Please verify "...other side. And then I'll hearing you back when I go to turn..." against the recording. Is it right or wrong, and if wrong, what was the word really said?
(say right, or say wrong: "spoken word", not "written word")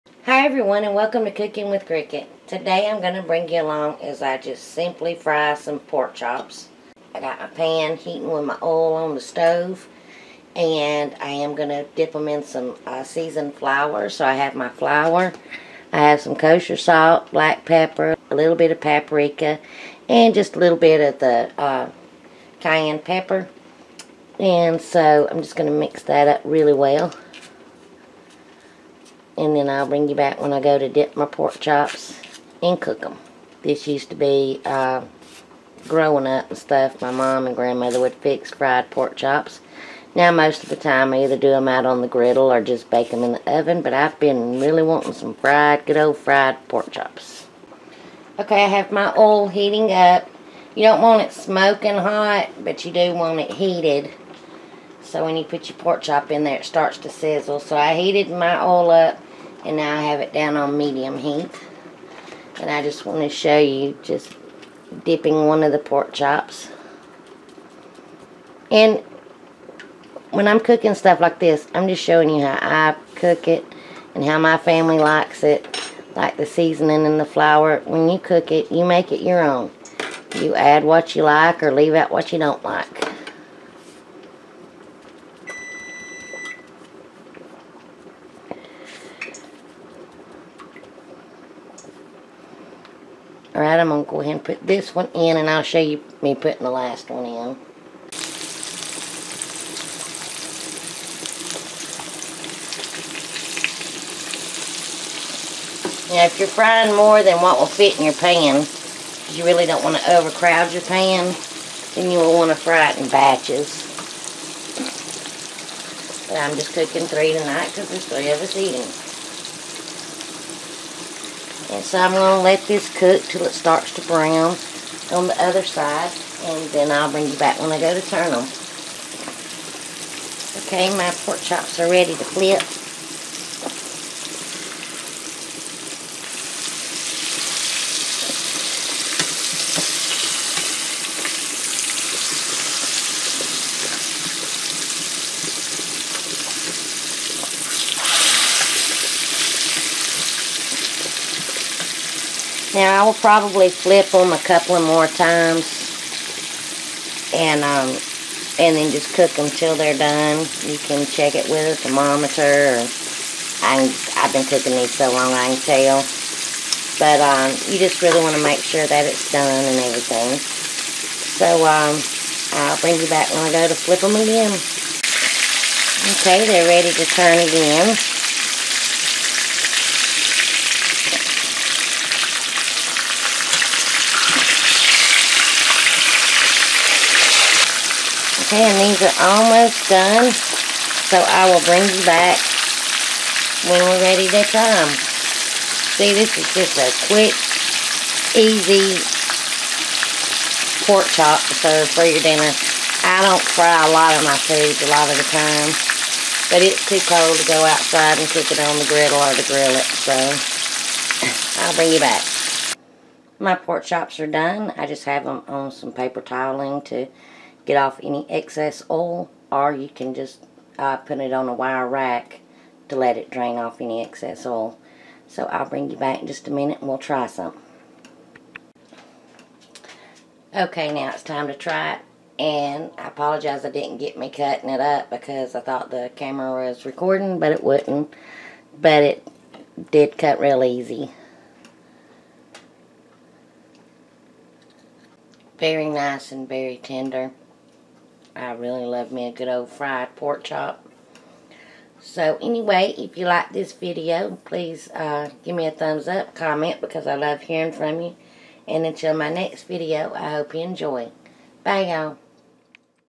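wrong: "bring", not "hearing".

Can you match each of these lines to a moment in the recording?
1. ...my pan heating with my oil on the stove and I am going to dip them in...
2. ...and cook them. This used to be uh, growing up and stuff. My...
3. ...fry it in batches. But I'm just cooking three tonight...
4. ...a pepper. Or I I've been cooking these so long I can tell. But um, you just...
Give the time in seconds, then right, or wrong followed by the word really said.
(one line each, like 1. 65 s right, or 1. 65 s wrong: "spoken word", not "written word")
1. 7 s right
2. 32 s right
3. 112 s right
4. 161 s wrong: "thermometer", not "pepper".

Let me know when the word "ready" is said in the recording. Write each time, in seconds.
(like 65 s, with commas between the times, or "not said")
131 s, 176 s, 194 s.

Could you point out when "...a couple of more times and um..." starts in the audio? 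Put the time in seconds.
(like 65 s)
154 s.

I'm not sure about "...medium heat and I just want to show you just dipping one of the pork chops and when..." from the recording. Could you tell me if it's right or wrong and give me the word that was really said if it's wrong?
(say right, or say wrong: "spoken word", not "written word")
right.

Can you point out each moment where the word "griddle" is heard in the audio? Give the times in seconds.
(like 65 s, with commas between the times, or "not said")
42 s, 208 s.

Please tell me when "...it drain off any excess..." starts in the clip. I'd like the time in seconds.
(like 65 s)
223 s.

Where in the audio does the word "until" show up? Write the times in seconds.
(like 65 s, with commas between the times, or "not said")
258 s.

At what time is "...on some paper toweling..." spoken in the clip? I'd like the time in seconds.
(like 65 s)
215 s.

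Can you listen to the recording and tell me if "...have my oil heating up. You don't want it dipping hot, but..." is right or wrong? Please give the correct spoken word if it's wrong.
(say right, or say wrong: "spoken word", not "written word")
wrong: "smoking", not "dipping".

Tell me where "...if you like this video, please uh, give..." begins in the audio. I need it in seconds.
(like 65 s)
252 s.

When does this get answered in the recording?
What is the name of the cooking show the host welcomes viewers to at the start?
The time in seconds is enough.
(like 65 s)
1 s.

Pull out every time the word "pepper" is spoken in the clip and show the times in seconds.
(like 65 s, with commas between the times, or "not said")
17 s, 22 s.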